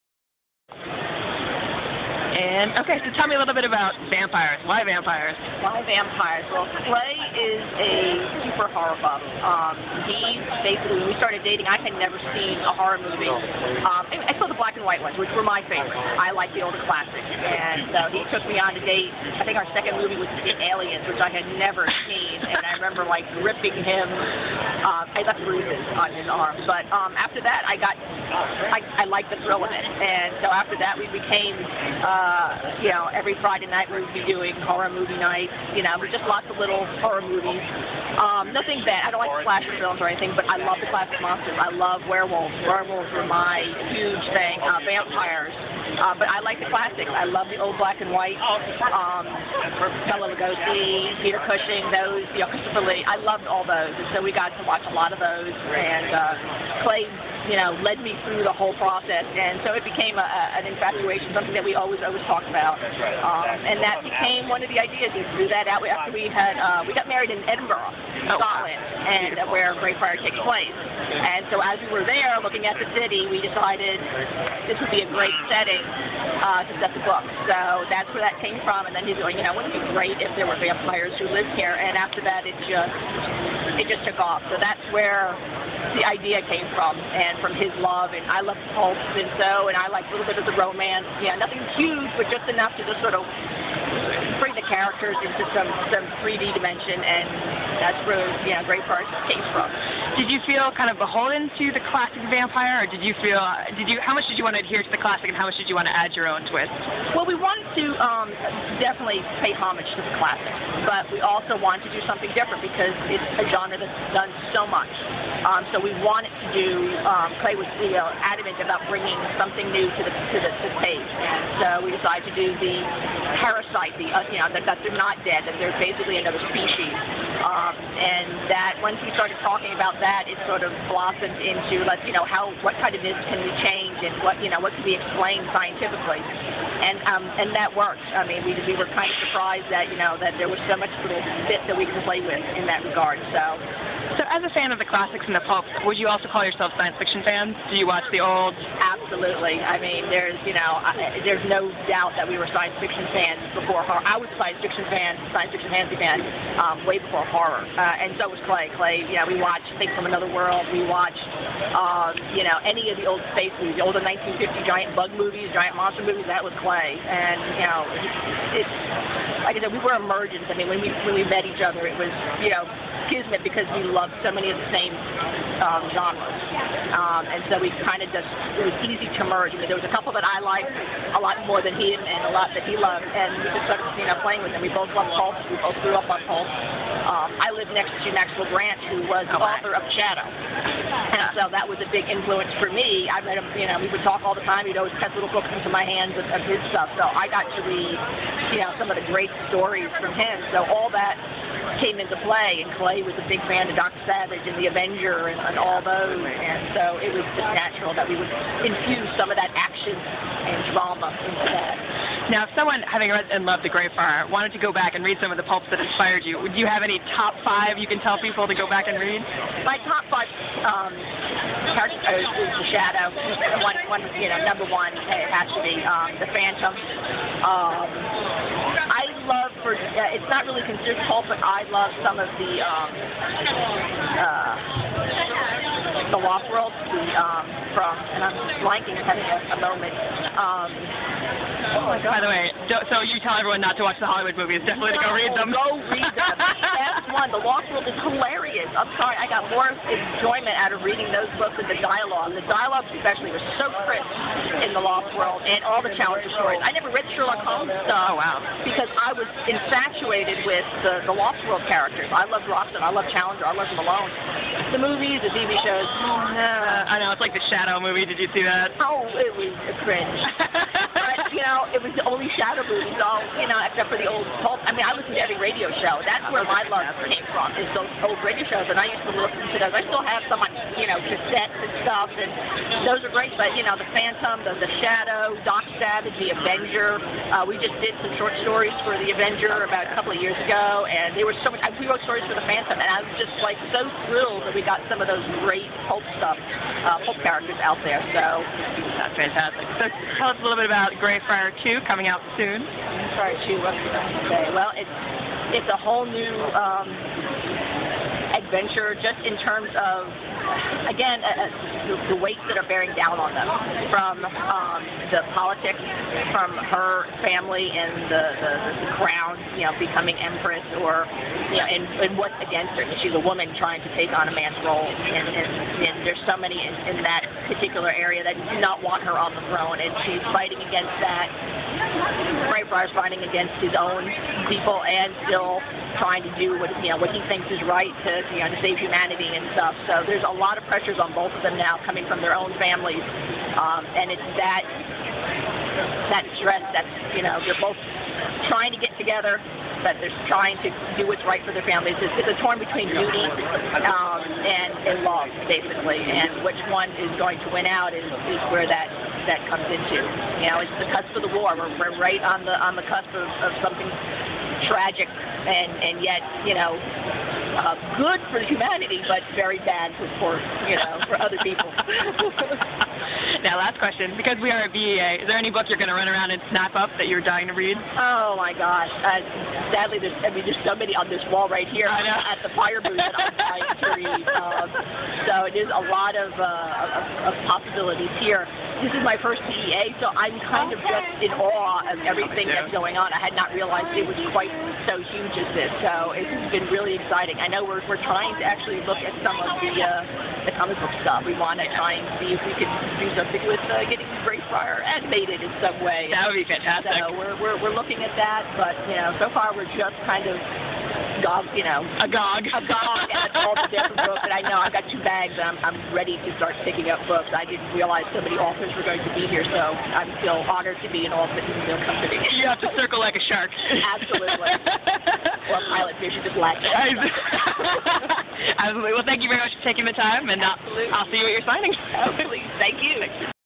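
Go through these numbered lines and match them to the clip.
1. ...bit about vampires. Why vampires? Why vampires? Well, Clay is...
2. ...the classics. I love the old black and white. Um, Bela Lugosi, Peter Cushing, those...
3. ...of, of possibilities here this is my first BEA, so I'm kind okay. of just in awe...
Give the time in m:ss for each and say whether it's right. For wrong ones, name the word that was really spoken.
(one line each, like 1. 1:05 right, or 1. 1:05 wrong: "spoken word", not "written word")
1. 0:03 right
2. 0:46 right
3. 6:26 right.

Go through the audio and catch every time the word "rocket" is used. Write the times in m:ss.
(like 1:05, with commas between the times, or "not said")
not said.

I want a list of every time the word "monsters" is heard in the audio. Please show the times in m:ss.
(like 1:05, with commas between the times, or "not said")
0:41, 2:45.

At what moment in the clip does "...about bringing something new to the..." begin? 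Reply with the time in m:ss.
1:58.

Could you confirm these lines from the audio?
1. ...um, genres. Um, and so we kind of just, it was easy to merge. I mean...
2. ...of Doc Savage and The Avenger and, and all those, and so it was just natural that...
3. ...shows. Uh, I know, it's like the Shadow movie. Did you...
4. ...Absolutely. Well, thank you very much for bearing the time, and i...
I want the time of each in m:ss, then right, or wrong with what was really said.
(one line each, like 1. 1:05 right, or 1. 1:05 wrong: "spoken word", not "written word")
1. 2:55 right
2. 3:23 right
3. 4:25 right
4. 7:08 wrong: "taking", not "bearing".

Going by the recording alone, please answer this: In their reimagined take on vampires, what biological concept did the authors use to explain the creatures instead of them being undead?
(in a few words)
parasite.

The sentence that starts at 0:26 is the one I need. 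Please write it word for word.
But um, after that, I got, I, I liked the thrill of it.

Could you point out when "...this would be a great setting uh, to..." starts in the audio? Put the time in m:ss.
1:14.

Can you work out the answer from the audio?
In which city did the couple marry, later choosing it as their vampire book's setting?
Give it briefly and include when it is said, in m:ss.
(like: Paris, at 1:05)
Edinburgh, at 1:07.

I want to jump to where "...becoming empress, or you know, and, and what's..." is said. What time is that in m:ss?
5:19.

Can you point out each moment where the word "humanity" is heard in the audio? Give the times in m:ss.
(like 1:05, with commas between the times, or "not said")
5:38, 6:08.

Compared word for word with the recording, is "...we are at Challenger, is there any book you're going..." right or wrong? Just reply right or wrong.
wrong.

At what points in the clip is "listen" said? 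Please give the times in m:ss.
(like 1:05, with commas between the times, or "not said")
4:34, 4:39.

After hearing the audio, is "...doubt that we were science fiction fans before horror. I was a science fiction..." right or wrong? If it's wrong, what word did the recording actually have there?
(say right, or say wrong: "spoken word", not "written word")
right.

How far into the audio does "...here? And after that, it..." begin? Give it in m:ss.
1:21.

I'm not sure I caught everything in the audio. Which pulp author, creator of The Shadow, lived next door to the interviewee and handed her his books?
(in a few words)
Maxwell Grant.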